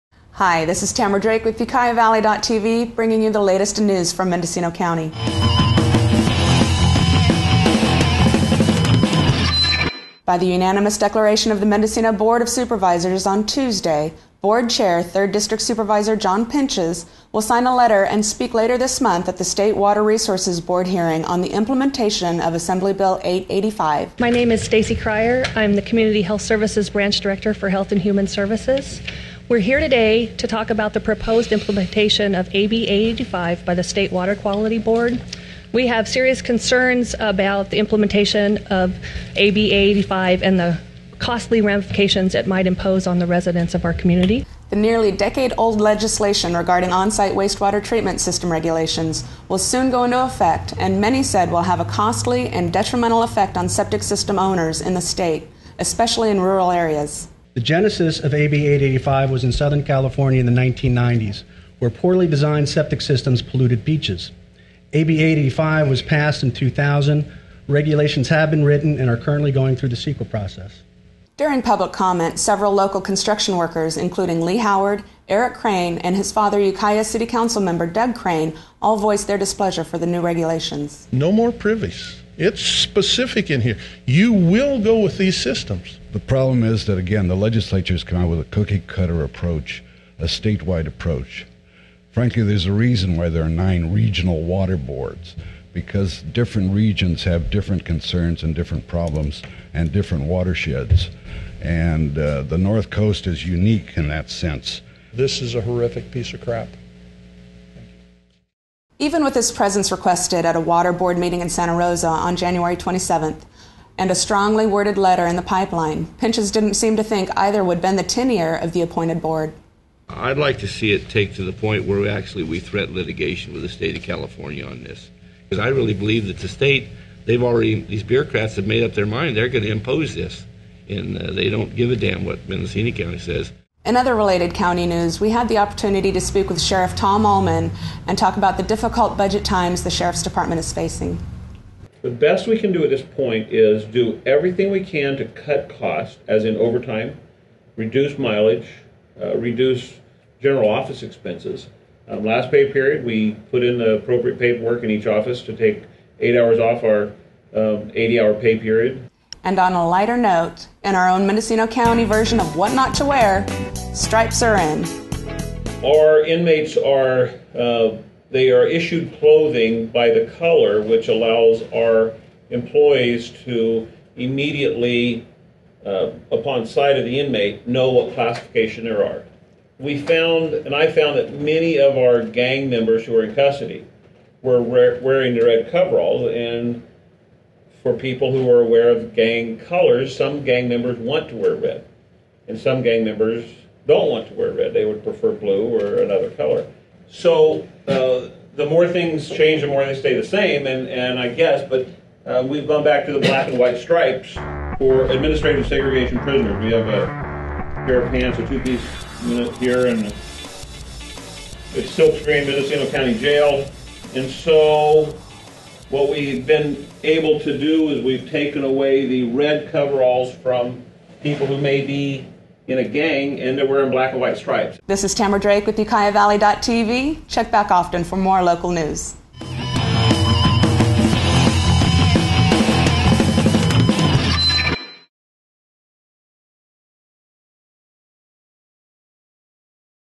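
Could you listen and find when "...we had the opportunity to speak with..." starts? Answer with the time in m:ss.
2:15.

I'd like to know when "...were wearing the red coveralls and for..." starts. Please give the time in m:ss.
3:04.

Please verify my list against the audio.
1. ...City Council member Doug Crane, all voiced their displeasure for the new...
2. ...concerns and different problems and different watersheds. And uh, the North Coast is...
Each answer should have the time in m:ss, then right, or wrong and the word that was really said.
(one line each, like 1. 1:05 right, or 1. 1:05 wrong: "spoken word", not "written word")
1. 1:17 right
2. 1:37 right.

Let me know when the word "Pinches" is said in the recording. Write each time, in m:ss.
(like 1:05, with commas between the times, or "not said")
0:16, 1:56.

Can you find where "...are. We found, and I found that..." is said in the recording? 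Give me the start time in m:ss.
2:59.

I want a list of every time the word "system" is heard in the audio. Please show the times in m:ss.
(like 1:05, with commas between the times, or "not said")
0:48, 0:54, 1:03, 1:25.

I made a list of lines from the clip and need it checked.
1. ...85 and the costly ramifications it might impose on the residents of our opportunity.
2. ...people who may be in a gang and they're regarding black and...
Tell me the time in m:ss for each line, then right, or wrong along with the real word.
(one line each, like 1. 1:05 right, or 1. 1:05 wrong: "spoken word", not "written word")
1. 0:39 wrong: "community", not "opportunity"
2. 3:41 wrong: "wearing", not "regarding".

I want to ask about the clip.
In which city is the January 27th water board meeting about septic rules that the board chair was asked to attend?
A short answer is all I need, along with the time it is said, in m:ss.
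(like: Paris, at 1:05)
Santa Rosa, at 1:51.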